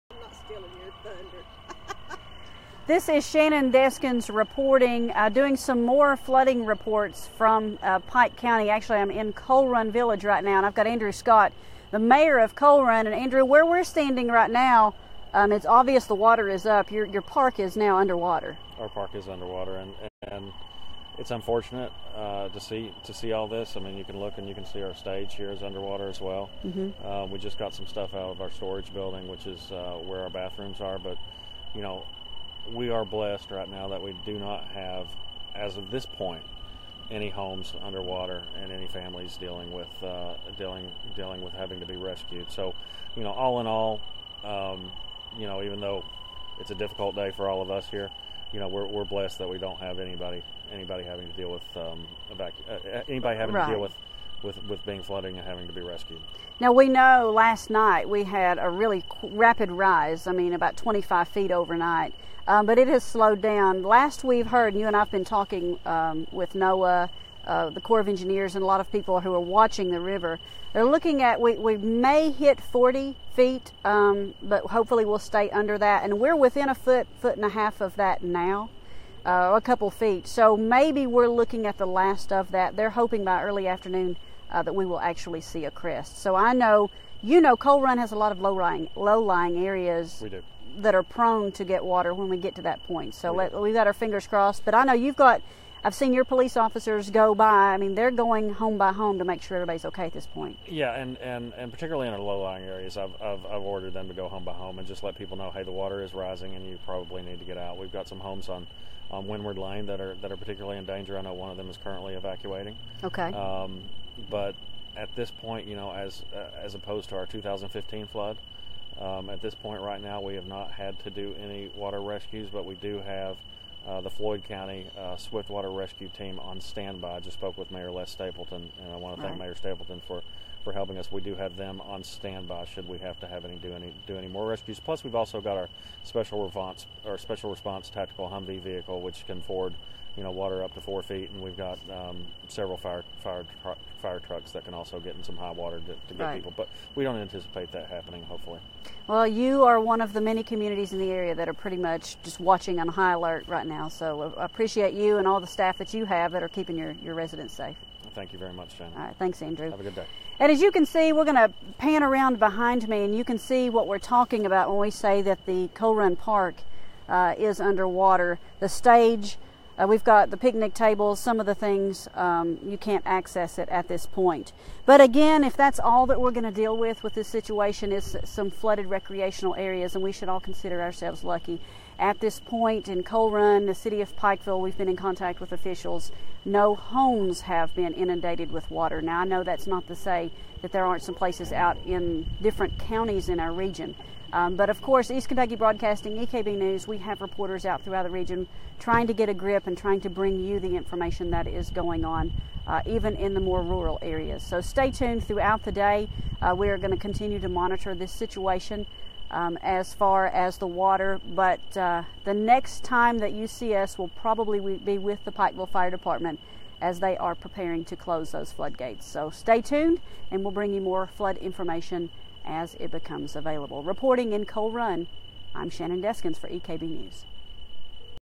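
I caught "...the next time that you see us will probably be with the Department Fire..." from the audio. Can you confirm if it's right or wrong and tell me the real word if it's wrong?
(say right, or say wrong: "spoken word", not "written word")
wrong: "Pikeville", not "Department".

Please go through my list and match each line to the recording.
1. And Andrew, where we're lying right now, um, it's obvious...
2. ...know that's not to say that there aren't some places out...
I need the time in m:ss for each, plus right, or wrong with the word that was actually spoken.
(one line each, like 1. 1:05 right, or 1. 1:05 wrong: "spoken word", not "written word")
1. 0:13 wrong: "standing", not "lying"
2. 3:09 right.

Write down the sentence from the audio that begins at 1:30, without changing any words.
That are prone to get water when we get to that point.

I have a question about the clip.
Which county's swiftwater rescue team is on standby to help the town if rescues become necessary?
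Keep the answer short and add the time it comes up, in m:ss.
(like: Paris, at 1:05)
Floyd County, at 2:04.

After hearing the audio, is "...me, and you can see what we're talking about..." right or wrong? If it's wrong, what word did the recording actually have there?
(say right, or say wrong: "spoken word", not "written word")
right.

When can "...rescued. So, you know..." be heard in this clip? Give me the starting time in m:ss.
0:41.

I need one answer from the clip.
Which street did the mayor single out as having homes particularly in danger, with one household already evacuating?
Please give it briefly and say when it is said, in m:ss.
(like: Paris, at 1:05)
Windward Lane, at 1:49.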